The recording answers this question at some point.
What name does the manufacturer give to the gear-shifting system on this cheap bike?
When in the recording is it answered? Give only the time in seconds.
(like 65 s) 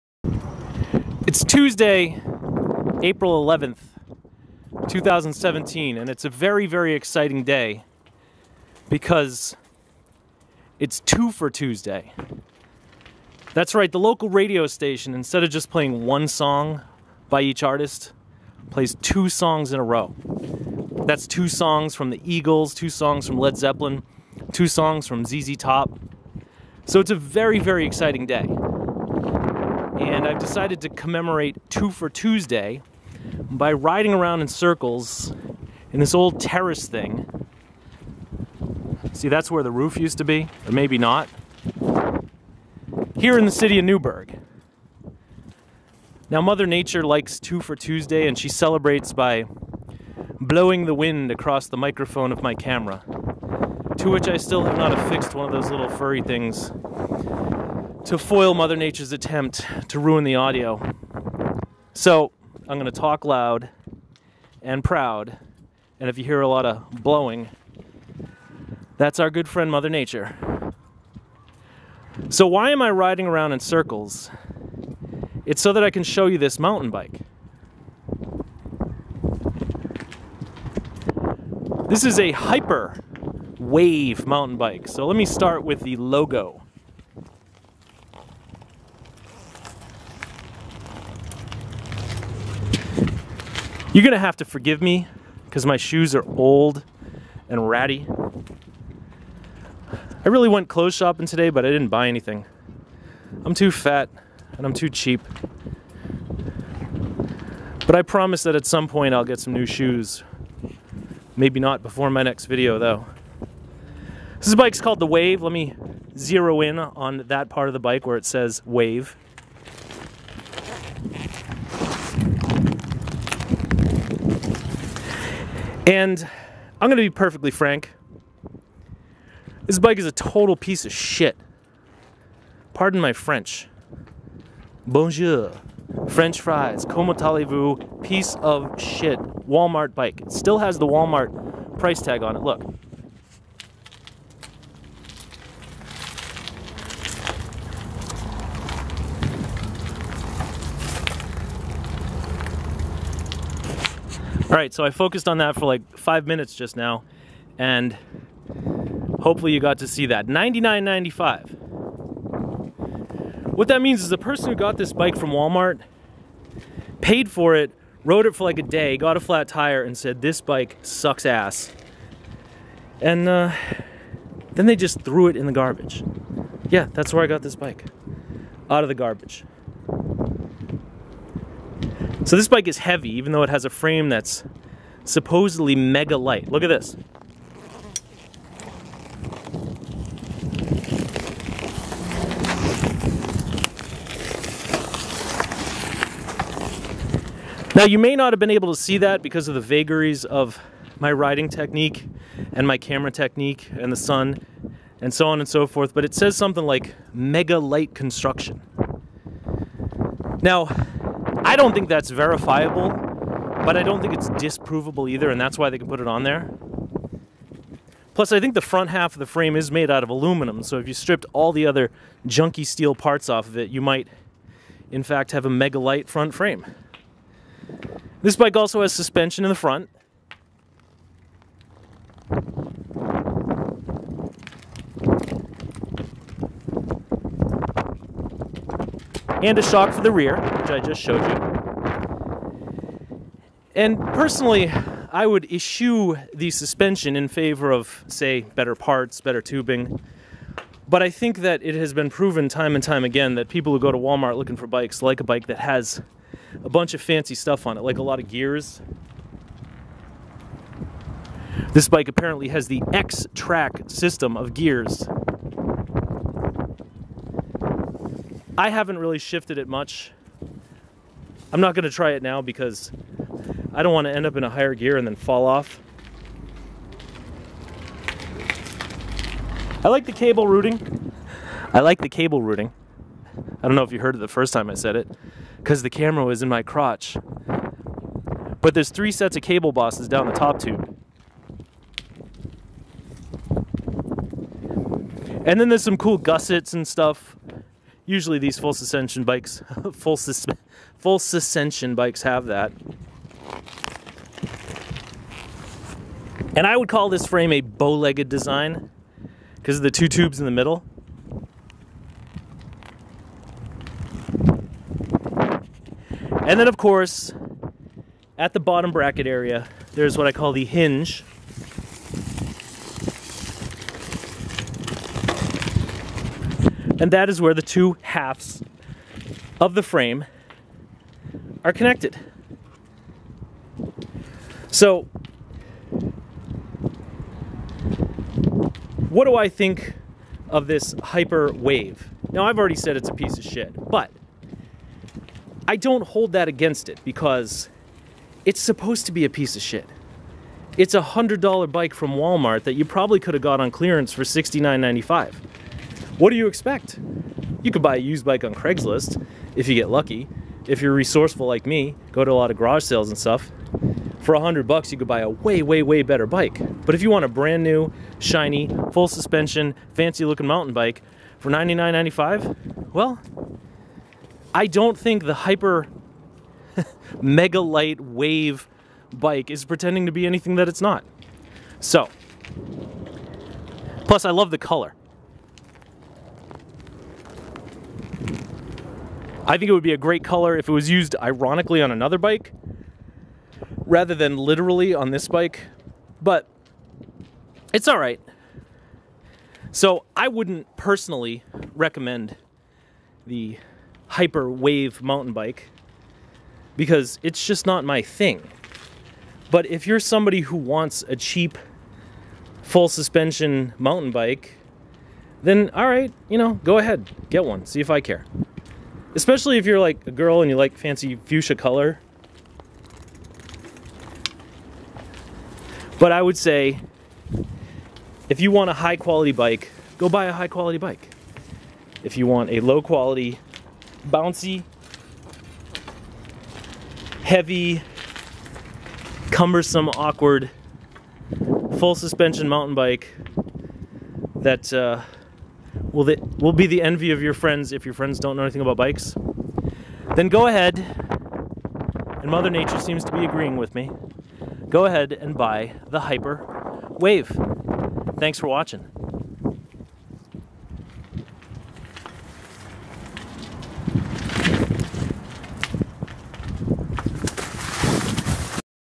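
262 s.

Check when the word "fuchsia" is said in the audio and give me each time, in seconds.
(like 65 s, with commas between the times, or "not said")
421 s.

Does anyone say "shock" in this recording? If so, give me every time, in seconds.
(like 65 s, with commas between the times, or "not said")
239 s.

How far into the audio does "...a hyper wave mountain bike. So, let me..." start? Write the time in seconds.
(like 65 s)
82 s.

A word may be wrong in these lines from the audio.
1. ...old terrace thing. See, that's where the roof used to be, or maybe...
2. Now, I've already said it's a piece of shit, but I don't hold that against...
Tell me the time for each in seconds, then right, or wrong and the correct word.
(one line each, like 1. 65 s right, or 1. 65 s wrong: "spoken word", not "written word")
1. 36 s right
2. 342 s right.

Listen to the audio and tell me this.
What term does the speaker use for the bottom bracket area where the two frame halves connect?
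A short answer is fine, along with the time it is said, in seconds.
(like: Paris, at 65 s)
the hinge, at 320 s.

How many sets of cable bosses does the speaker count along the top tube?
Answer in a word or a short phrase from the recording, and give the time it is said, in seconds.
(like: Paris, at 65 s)
3, at 288 s.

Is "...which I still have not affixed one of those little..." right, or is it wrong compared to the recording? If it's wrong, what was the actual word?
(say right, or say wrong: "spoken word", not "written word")
right.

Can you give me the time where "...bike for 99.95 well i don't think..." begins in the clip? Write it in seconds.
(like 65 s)
370 s.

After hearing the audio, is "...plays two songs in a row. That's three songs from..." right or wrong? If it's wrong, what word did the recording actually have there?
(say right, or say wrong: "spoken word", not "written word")
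wrong: "two", not "three".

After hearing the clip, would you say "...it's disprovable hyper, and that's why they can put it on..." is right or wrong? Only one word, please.
wrong.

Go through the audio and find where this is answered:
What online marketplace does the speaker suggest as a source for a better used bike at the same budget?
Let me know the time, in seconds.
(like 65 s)
358 s.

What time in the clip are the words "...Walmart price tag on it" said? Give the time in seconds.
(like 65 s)
140 s.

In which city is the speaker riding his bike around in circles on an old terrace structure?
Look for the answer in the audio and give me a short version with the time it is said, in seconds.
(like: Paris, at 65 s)
Newburgh, at 43 s.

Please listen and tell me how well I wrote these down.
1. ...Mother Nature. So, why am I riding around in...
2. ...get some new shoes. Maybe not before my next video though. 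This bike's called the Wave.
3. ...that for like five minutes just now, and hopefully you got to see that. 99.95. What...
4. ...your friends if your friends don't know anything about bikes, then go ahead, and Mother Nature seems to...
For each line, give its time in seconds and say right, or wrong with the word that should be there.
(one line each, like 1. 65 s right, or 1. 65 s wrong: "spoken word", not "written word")
1. 69 s right
2. 109 s right
3. 155 s right
4. 447 s right.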